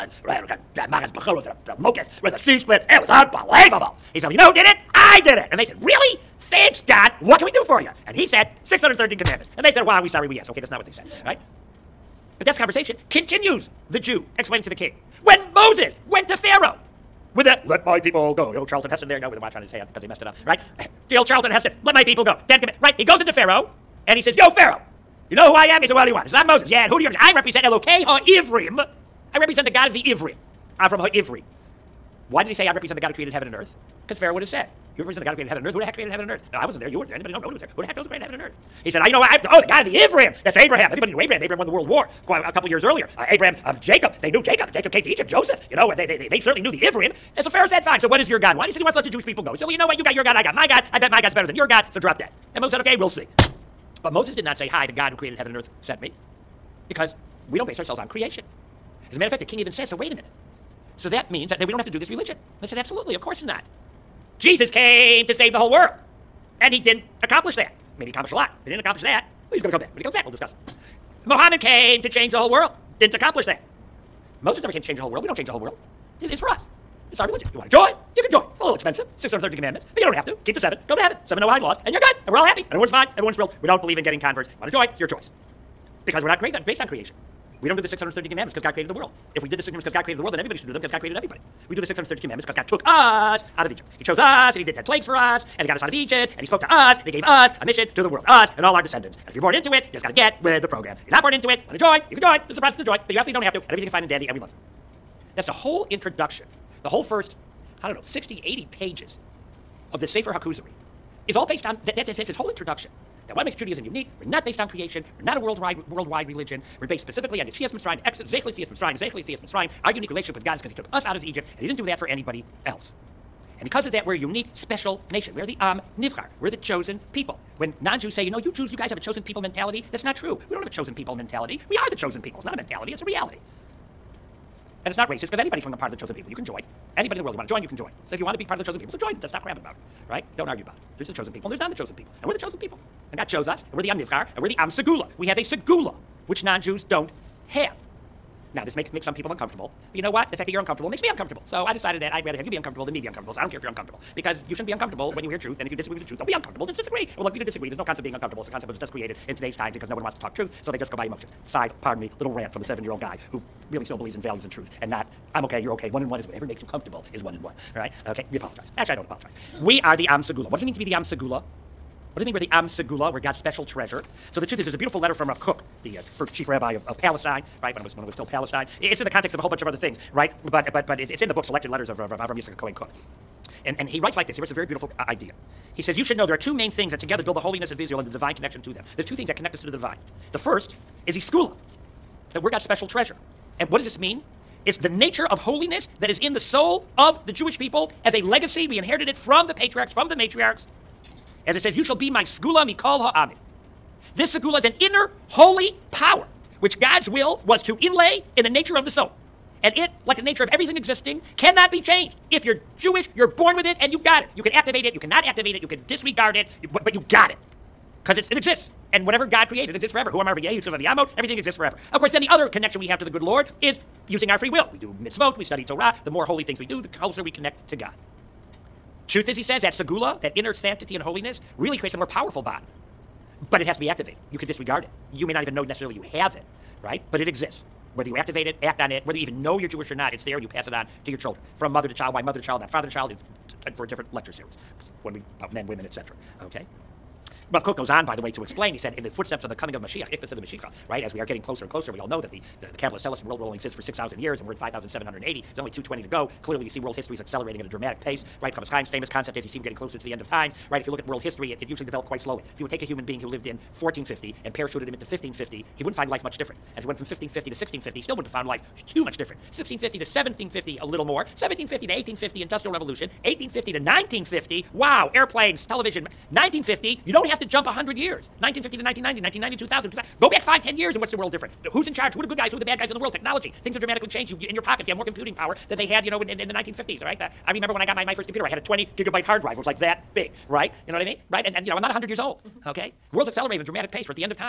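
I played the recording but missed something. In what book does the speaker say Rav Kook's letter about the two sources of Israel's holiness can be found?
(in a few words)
Selected Letters.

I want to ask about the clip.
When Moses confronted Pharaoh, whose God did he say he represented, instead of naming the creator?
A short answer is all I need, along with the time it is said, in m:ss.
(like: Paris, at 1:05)
Elokei HaIvrim, at 0:27.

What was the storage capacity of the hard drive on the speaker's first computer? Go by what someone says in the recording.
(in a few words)
20 gigabytes.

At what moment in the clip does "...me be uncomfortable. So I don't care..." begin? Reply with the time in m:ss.
2:32.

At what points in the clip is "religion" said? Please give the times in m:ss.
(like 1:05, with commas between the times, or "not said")
1:02, 1:17, 1:56.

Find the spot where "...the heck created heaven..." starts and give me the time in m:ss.
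0:35.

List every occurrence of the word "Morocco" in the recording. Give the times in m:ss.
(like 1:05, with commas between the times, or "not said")
not said.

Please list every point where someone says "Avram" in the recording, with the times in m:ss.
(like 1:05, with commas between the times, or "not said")
0:30, 3:02.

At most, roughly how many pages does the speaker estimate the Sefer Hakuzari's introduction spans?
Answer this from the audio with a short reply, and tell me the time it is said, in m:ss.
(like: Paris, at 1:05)
80, at 1:48.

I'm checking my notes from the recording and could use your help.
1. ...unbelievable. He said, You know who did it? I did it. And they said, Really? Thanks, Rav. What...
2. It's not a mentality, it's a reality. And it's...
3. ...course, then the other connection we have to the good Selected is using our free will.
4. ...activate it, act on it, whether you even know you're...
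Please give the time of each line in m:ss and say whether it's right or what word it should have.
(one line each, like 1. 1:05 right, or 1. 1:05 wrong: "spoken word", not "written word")
1. 0:03 wrong: "God", not "Rav"
2. 2:12 right
3. 3:41 wrong: "Lord", not "Selected"
4. 3:58 right.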